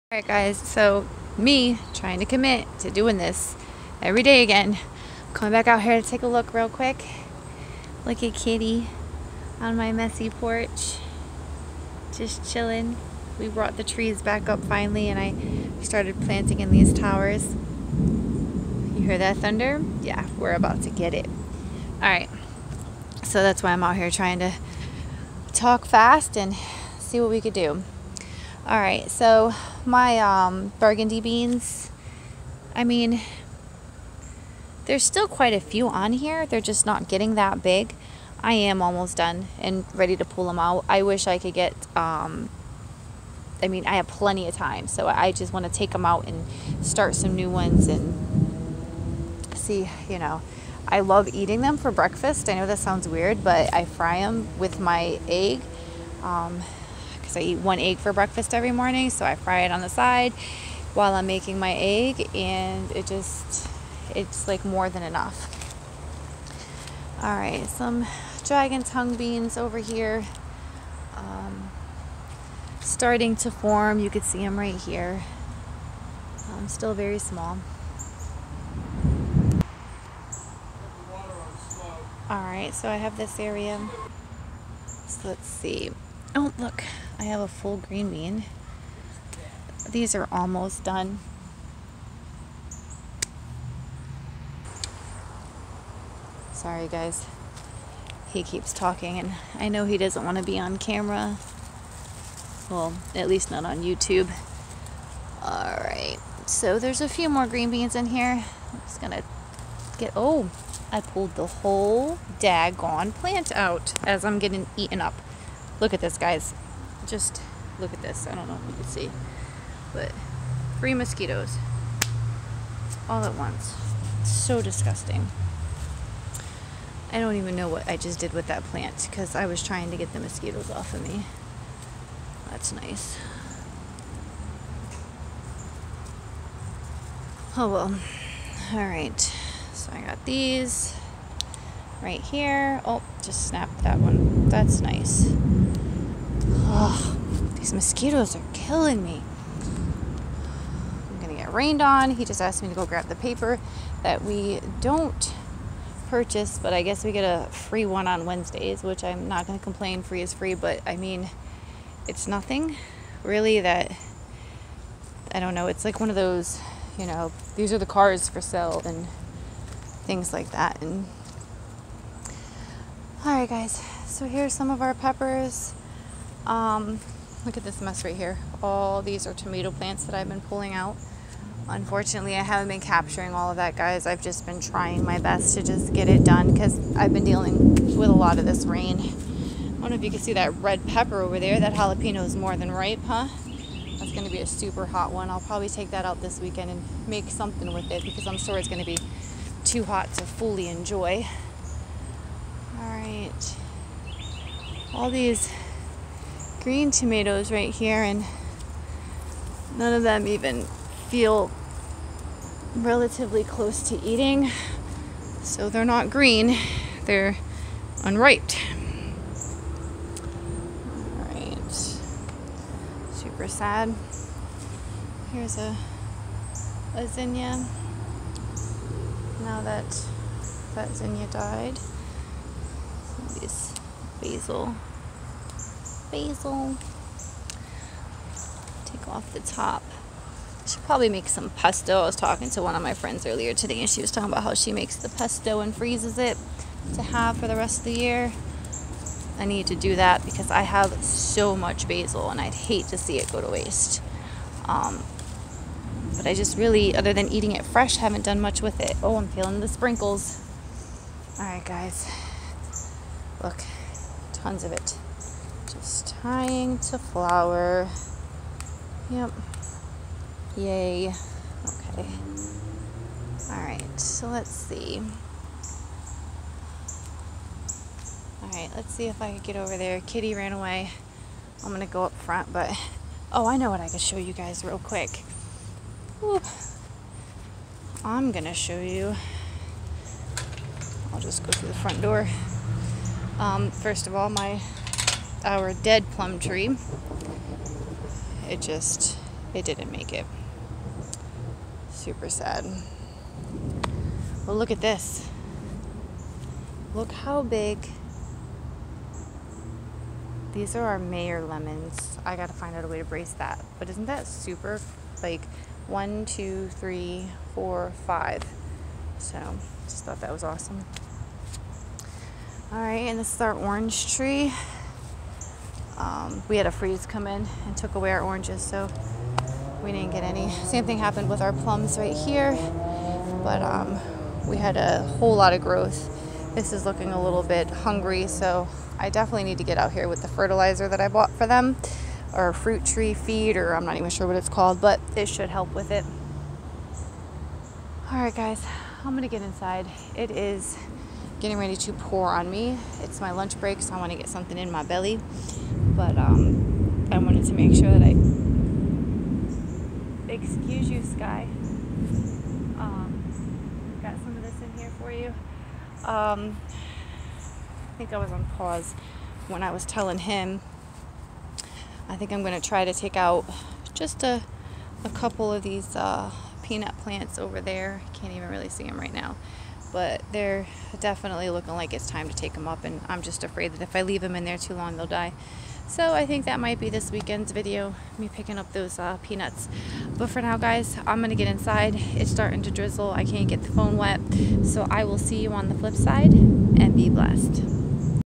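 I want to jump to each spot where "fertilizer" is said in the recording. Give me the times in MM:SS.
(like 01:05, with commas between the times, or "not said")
05:40.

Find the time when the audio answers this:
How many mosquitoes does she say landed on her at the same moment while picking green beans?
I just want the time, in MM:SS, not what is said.
02:00.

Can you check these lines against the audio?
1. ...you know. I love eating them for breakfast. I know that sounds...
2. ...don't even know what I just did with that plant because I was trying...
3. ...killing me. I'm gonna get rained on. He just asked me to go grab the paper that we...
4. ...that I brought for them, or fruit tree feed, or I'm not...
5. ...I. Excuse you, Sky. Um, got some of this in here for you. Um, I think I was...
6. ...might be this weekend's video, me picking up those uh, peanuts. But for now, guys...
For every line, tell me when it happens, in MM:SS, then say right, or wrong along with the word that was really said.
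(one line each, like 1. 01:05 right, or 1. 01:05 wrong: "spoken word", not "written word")
1. 00:50 right
2. 02:07 right
3. 02:28 right
4. 05:40 wrong: "bought", not "brought"
5. 05:58 right
6. 06:26 right.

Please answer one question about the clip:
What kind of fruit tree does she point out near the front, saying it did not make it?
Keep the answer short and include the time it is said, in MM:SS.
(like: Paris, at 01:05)
Plum tree, at 04:55.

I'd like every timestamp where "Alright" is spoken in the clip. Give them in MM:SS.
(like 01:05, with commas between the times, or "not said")
00:00, 00:22, 01:45, 03:41, 04:33, 04:38.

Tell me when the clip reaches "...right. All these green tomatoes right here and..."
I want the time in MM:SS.
03:22.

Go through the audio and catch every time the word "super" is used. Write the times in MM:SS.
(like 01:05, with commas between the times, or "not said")
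03:14, 03:43, 05:01, 05:14.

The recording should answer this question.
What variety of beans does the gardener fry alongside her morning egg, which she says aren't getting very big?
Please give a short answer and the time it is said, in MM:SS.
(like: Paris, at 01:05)
Burgundy beans, at 00:30.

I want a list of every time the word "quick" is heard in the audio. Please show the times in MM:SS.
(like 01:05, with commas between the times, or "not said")
00:06, 04:44.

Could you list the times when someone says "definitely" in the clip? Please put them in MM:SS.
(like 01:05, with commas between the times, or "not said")
05:39, 06:21.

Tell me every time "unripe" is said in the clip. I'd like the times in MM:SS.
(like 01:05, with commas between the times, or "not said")
03:38.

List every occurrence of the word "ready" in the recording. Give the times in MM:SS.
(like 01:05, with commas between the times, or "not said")
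00:39, 05:51.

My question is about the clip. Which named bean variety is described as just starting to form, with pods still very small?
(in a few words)
Dragon tongue beans.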